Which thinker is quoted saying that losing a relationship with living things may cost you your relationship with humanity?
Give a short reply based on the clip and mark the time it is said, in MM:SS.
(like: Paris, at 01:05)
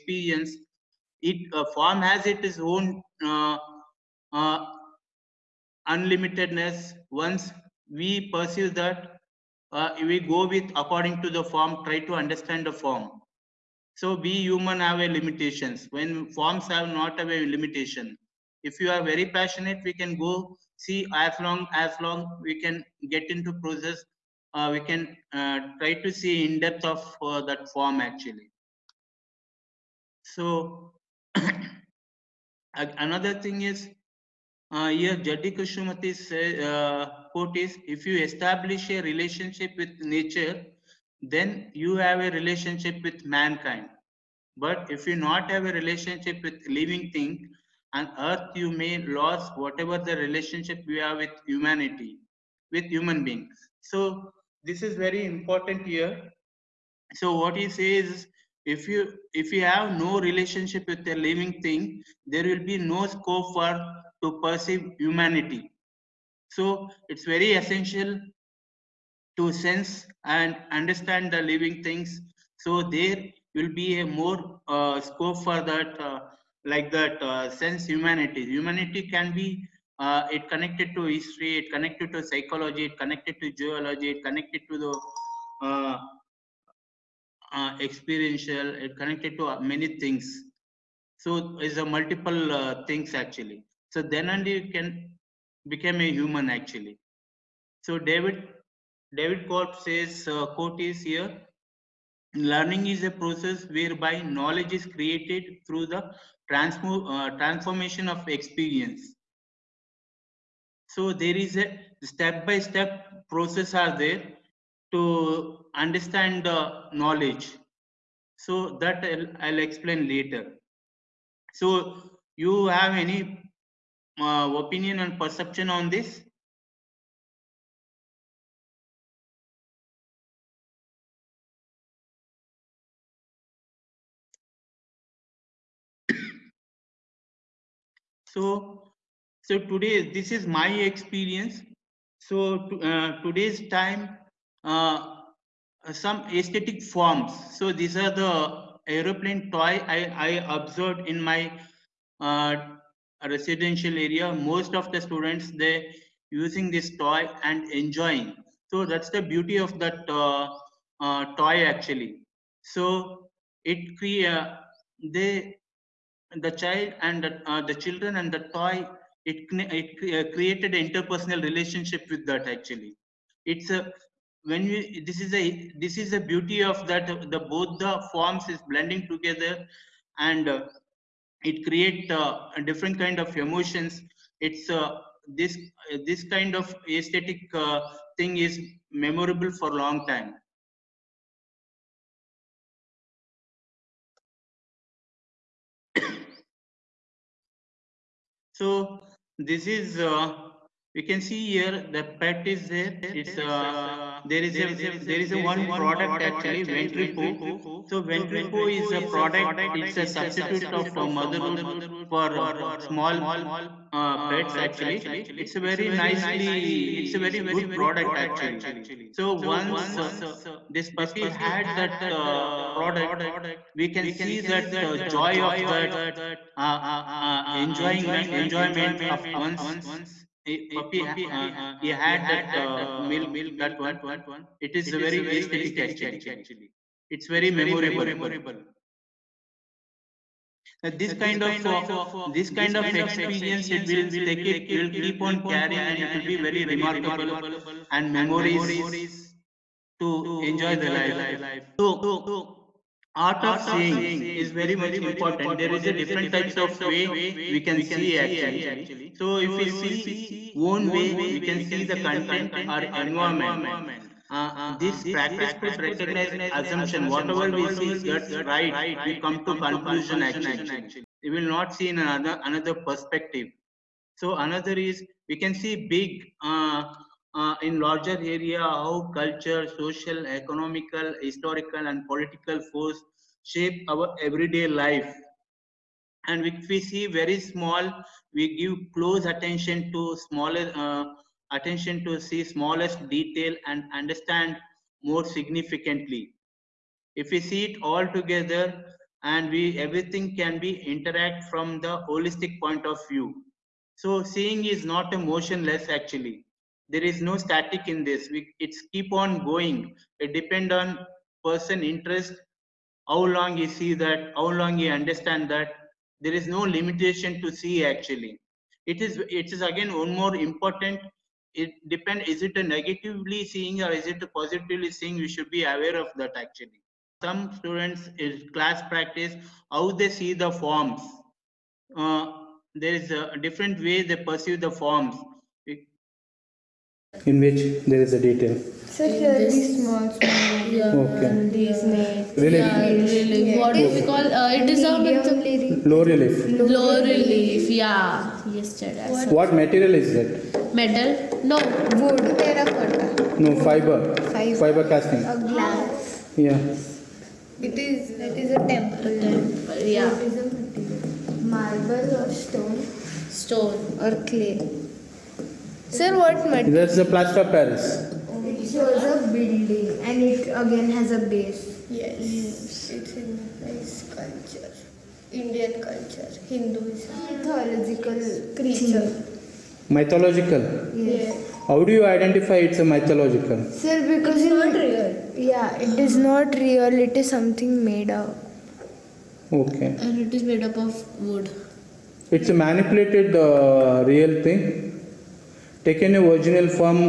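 Jiddu Krishnamurti, at 00:35.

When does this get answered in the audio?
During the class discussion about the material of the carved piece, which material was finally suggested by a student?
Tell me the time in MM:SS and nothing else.
06:07.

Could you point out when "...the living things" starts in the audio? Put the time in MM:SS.
01:11.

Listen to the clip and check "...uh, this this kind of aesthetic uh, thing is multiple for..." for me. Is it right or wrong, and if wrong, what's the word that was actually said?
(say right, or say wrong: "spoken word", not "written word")
wrong: "memorable", not "multiple".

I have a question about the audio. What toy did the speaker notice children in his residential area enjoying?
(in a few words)
aeroplane toy.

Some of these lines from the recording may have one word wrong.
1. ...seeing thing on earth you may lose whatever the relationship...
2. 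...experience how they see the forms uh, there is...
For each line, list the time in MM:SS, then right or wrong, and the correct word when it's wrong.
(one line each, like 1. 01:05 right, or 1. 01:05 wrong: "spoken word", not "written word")
1. 00:46 wrong: "living", not "seeing"
2. 05:28 wrong: "practice", not "experience".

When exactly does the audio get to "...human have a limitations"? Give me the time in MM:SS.
00:14.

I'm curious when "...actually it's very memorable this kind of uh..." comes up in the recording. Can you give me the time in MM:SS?
03:55.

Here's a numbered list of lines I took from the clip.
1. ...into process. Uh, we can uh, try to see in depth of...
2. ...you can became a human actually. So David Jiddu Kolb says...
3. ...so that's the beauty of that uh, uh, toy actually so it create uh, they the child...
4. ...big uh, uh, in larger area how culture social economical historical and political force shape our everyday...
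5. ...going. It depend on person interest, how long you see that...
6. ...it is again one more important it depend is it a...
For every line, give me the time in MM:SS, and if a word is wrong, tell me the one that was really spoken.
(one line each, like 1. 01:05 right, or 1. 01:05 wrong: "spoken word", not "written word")
1. 00:23 right
2. 01:34 wrong: "David", not "Jiddu"
3. 02:38 right
4. 04:35 right
5. 05:09 right
6. 05:19 right.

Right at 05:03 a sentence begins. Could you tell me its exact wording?
So seeing is not a motionless actually.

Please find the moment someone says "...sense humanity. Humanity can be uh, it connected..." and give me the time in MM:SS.
01:17.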